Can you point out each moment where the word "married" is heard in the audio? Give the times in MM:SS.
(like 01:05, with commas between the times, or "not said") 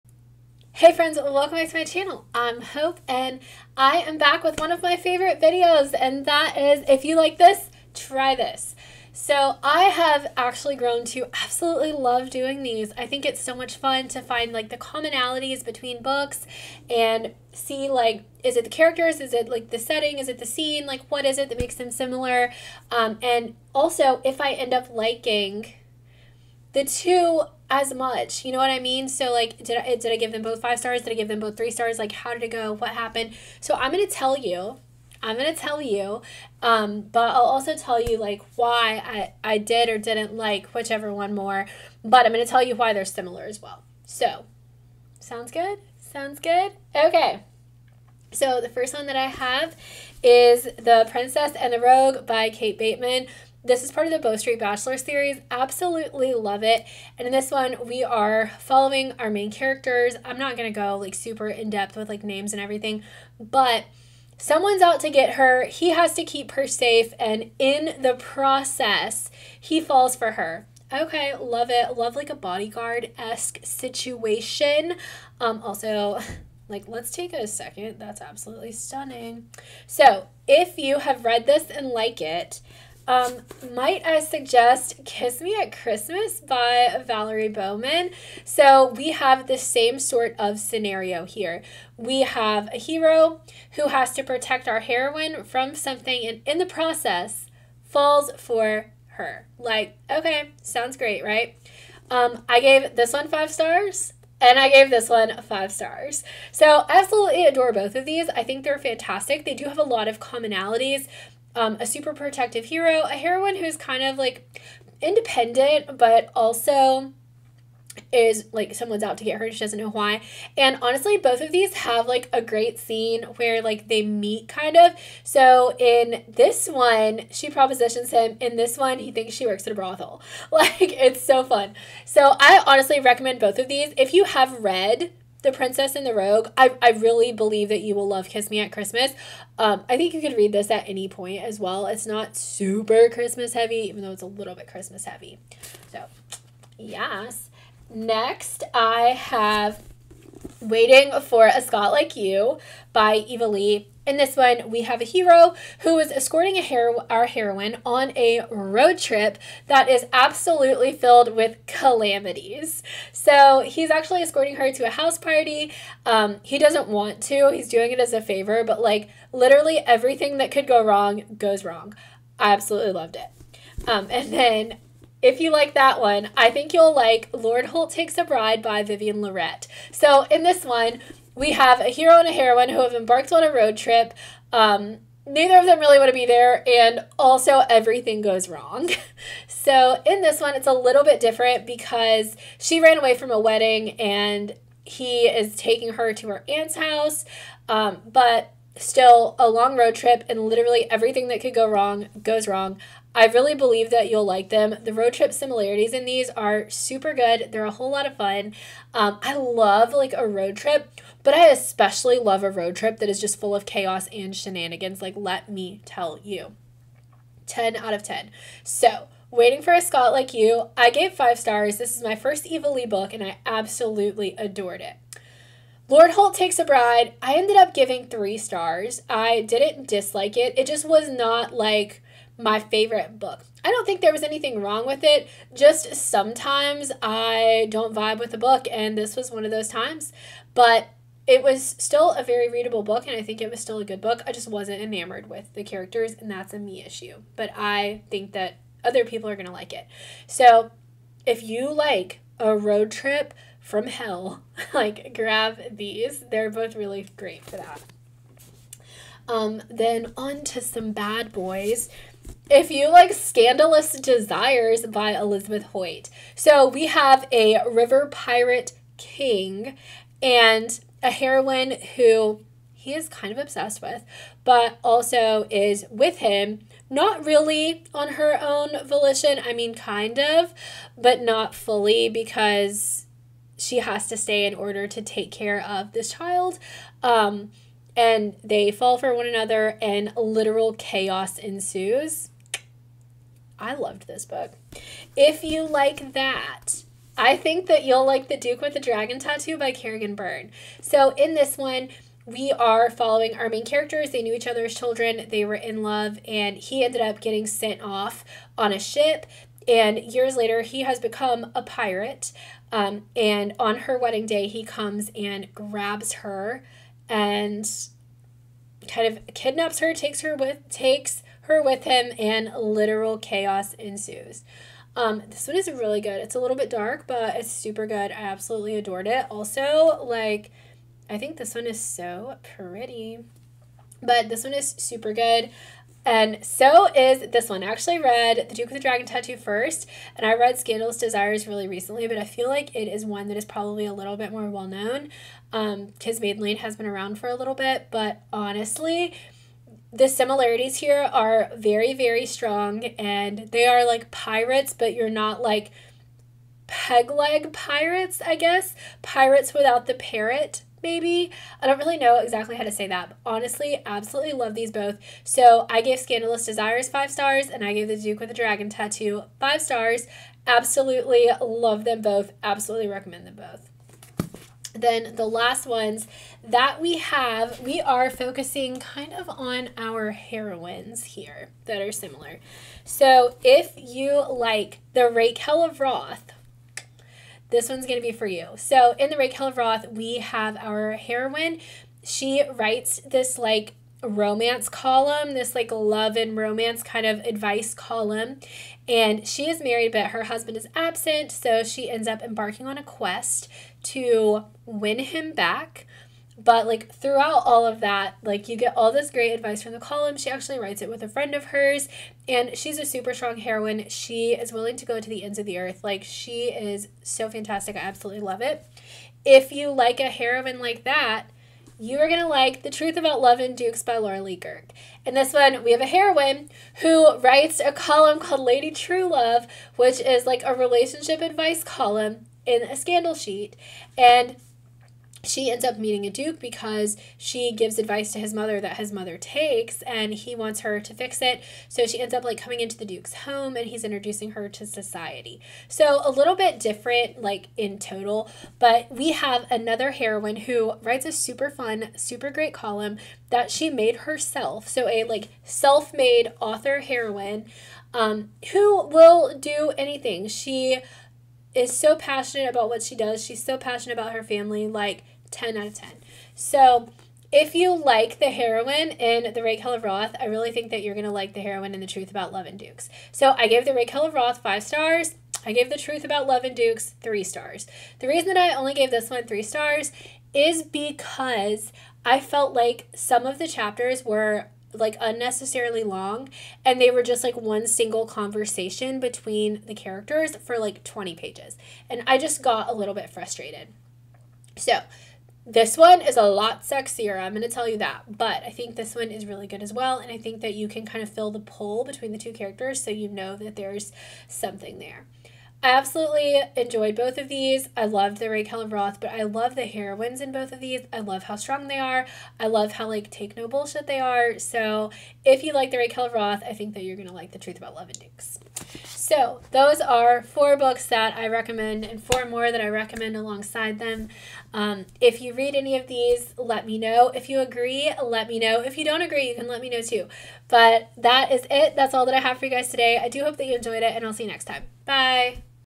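06:39.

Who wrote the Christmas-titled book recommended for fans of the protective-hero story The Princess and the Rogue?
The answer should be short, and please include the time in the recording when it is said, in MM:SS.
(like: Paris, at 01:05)
Valerie Bowman, at 01:27.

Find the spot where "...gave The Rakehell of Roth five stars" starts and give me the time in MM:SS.
07:53.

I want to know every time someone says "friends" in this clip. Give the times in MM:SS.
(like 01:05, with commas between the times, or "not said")
00:00, 06:51.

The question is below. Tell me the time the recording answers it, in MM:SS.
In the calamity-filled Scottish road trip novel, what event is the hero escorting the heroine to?
02:44.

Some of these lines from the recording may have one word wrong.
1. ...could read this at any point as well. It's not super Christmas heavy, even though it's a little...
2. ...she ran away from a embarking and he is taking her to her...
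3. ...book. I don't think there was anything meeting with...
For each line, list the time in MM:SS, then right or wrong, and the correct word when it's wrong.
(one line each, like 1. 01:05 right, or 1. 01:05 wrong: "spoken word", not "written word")
1. 02:20 right
2. 03:12 wrong: "wedding", not "embarking"
3. 03:53 wrong: "wrong", not "meeting".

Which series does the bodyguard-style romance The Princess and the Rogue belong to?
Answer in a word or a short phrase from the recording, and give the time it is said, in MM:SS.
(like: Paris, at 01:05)
Bow Street Bachelor, at 00:54.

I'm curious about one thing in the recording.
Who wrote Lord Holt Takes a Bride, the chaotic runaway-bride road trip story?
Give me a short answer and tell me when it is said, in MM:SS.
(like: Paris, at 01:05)
Vivienne Lorret, at 02:58.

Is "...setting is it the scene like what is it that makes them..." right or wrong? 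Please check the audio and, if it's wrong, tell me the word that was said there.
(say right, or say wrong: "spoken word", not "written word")
right.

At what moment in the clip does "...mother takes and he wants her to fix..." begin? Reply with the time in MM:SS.
07:18.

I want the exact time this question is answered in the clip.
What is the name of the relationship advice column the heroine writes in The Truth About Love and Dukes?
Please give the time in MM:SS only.
07:08.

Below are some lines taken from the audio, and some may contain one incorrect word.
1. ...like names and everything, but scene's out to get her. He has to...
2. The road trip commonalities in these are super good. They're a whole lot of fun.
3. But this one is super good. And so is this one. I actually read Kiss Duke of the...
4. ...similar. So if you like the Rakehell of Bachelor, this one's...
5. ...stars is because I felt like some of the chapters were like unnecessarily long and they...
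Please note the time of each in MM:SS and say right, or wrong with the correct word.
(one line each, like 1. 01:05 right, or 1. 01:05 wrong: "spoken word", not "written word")
1. 01:02 wrong: "someone", not "scene"
2. 03:24 wrong: "similarities", not "commonalities"
3. 05:34 wrong: "The", not "Kiss"
4. 06:21 wrong: "Roth", not "Bachelor"
5. 07:59 right.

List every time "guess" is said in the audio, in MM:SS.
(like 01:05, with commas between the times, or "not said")
05:58.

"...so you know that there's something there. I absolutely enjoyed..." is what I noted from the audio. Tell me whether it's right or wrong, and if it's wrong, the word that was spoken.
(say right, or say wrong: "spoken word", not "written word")
right.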